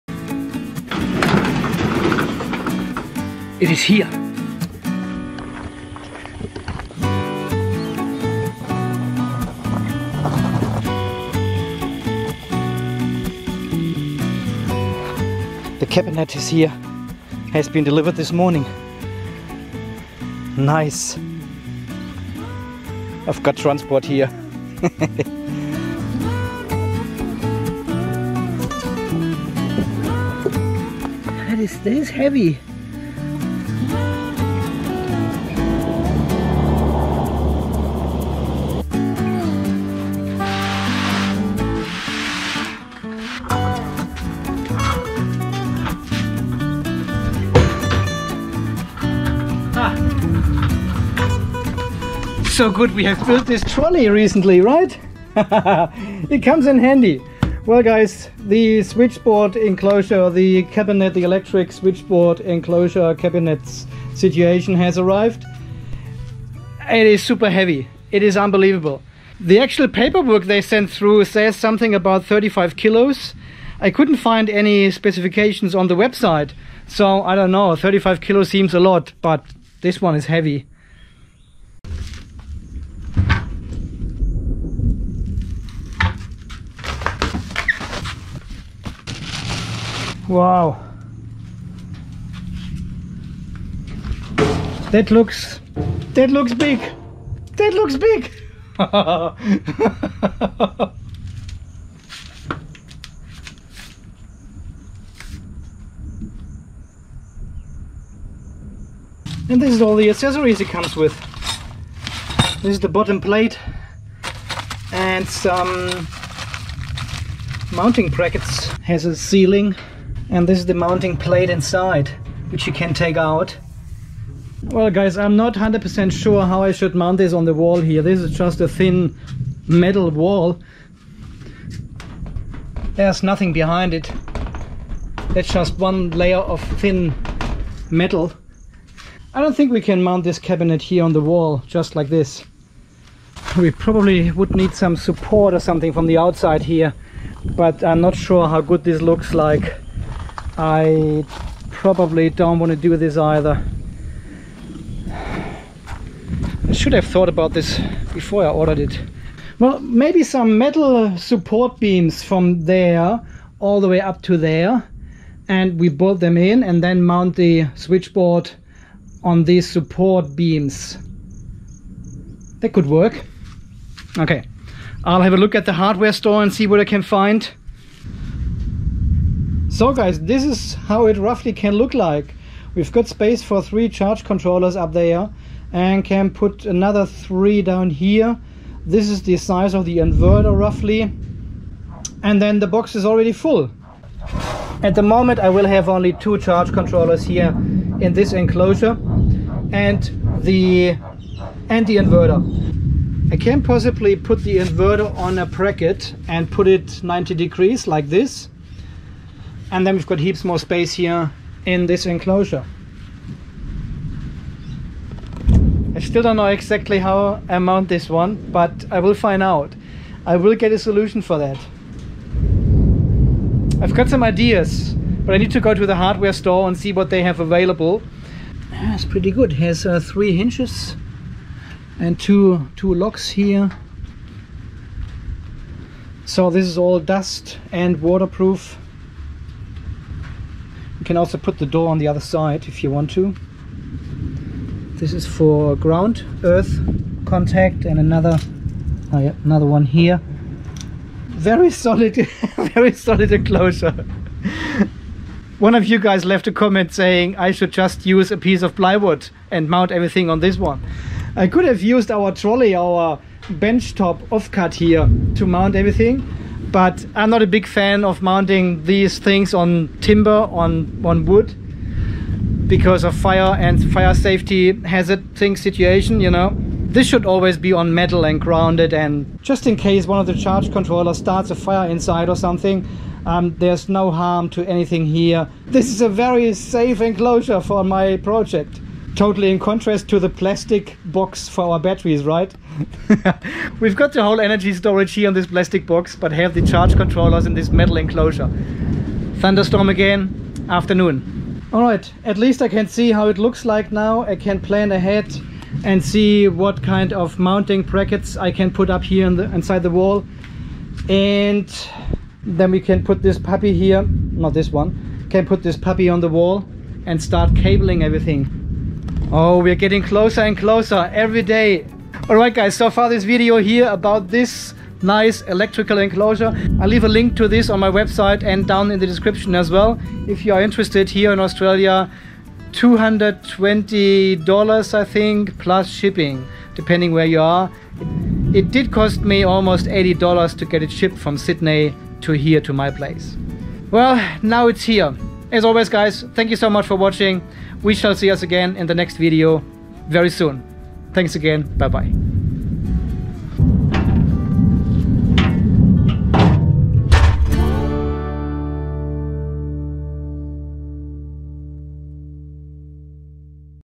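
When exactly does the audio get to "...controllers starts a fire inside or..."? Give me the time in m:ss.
4:40.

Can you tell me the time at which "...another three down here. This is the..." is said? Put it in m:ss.
3:06.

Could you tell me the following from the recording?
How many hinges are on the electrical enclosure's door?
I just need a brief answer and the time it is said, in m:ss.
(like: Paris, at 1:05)
3, at 3:49.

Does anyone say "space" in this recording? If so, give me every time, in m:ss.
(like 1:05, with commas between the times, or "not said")
3:03, 3:30.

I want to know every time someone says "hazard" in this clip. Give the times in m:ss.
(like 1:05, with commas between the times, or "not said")
4:34.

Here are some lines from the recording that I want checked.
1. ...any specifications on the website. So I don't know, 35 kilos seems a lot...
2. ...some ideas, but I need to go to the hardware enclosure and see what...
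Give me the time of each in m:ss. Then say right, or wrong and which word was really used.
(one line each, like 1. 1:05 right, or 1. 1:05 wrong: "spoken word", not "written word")
1. 1:14 right
2. 3:44 wrong: "store", not "enclosure".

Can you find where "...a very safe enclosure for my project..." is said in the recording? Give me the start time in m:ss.
4:46.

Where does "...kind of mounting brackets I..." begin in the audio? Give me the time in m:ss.
5:06.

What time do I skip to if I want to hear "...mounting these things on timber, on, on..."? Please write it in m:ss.
4:28.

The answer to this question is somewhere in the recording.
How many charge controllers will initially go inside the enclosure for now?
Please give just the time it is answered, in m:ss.
3:16.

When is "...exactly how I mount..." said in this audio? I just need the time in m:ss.
3:36.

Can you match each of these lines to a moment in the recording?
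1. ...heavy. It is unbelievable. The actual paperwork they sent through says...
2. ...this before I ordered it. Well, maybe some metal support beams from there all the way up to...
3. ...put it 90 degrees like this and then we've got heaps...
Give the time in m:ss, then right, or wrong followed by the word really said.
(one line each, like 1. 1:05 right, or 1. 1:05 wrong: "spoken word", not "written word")
1. 1:07 right
2. 2:37 right
3. 3:26 right.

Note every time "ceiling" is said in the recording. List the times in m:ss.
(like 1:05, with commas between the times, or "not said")
1:59.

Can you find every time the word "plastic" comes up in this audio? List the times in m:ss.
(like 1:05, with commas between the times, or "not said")
4:50, 4:55.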